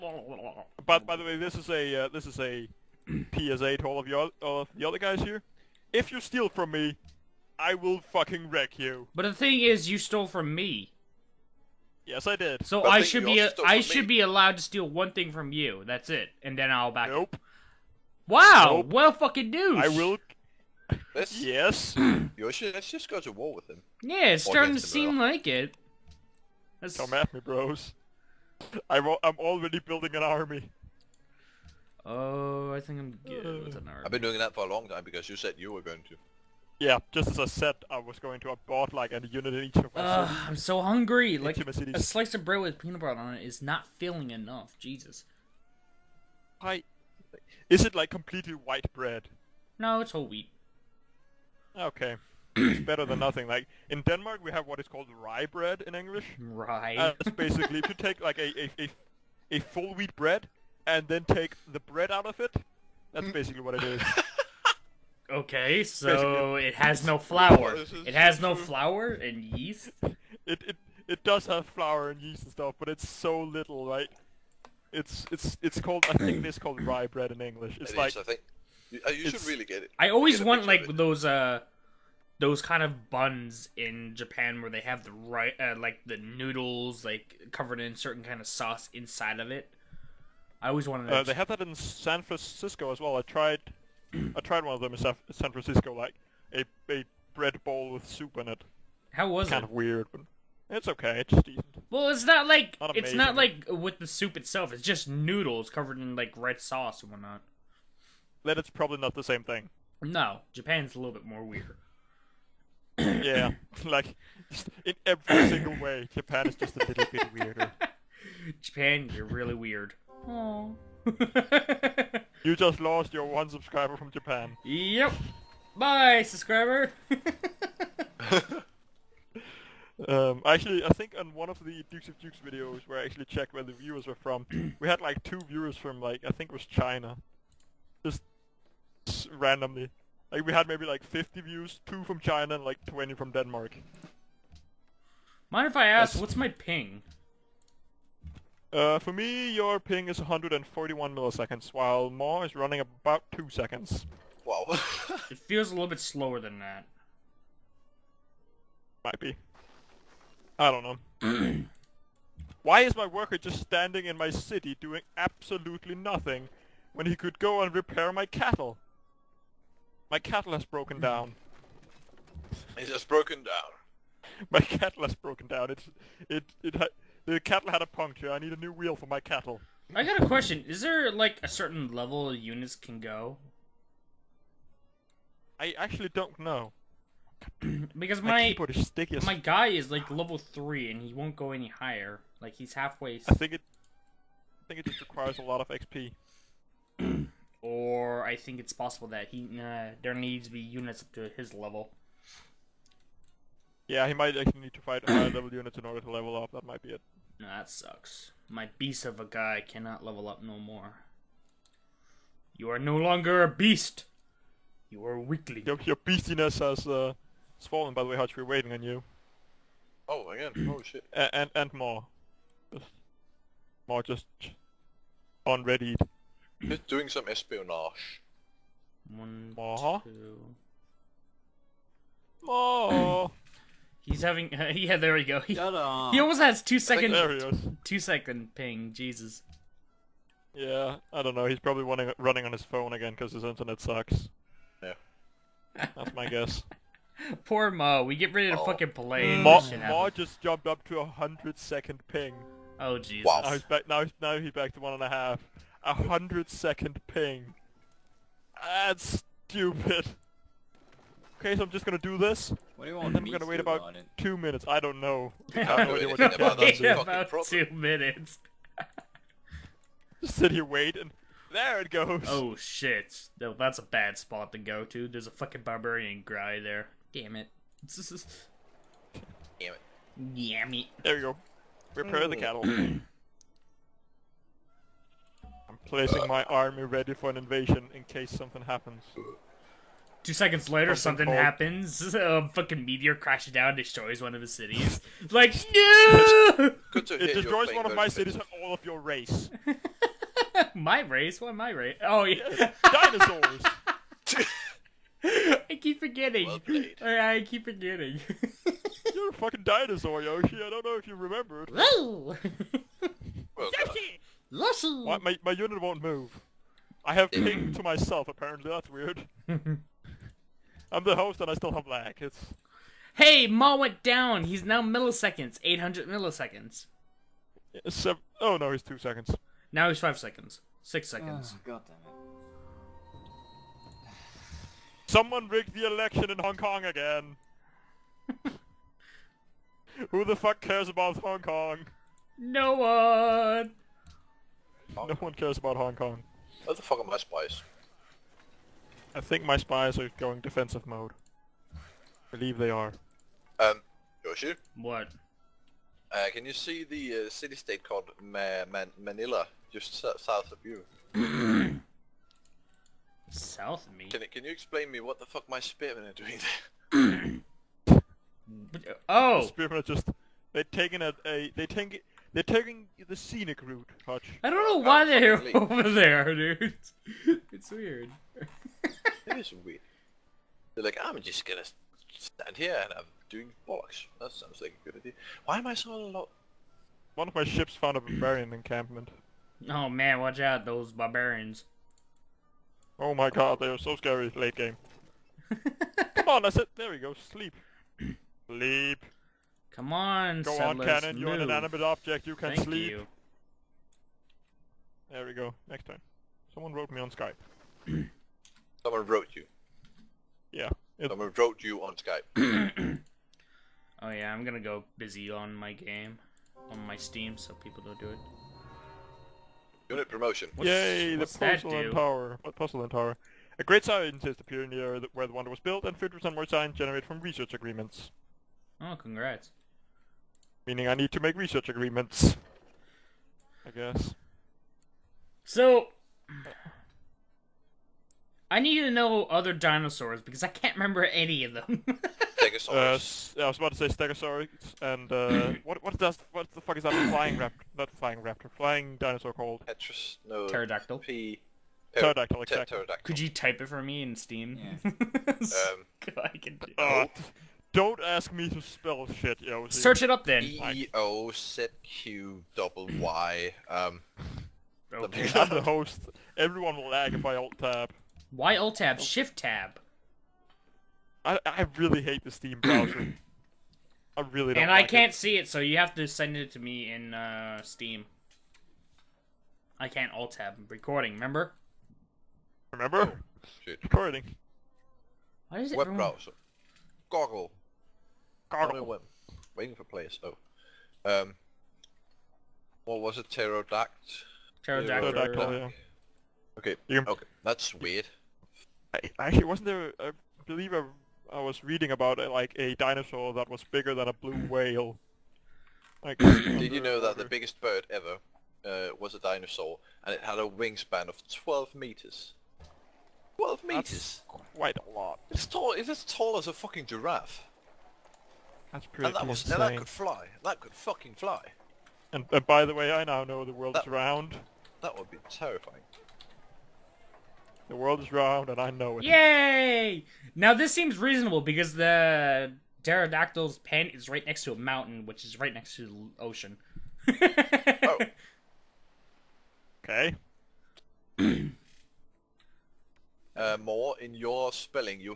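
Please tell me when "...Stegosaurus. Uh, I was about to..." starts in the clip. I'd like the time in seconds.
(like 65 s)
442 s.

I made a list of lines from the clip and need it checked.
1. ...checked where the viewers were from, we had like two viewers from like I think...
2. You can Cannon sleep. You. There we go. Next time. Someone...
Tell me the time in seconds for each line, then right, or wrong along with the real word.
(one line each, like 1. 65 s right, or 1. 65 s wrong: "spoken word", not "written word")
1. 133 s right
2. 402 s wrong: "Thank", not "Cannon".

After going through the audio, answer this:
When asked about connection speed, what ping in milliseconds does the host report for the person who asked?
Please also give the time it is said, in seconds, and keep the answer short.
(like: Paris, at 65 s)
141 milliseconds, at 150 s.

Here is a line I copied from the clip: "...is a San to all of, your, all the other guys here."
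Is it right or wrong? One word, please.
wrong.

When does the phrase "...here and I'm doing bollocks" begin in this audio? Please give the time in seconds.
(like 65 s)
382 s.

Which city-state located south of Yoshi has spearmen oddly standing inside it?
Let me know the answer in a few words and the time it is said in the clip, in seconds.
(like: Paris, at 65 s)
Manila, at 359 s.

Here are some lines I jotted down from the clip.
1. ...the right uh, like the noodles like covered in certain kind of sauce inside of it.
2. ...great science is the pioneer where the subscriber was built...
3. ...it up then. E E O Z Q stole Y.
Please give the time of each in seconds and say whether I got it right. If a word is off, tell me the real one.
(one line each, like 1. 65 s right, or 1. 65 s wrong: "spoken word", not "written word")
1. 85 s right
2. 423 s wrong: "wonder", not "subscriber"
3. 460 s wrong: "double", not "stole".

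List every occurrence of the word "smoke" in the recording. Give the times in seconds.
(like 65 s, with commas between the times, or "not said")
not said.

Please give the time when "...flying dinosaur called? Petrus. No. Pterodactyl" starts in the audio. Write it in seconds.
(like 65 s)
448 s.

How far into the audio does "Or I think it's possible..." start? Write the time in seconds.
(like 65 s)
197 s.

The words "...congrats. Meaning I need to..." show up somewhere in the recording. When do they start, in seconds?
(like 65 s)
428 s.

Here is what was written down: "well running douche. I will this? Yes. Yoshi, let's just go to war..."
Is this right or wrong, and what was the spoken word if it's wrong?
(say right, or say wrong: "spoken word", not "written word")
wrong: "fucking", not "running".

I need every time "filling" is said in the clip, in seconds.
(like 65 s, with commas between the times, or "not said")
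43 s.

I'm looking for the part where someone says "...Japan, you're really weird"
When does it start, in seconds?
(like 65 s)
118 s.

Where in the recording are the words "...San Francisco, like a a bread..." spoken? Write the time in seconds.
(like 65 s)
94 s.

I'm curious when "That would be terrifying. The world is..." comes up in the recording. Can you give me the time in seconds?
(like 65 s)
524 s.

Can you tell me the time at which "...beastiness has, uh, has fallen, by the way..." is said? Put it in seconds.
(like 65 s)
215 s.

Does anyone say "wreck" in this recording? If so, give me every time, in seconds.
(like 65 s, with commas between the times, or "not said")
8 s.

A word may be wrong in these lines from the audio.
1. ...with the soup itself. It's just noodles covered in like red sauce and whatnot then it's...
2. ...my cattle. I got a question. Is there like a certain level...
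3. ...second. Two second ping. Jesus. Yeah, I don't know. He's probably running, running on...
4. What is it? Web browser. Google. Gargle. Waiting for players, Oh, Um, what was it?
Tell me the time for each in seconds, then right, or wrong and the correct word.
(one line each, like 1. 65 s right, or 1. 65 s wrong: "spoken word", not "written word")
1. 103 s right
2. 179 s right
3. 236 s right
4. 485 s right.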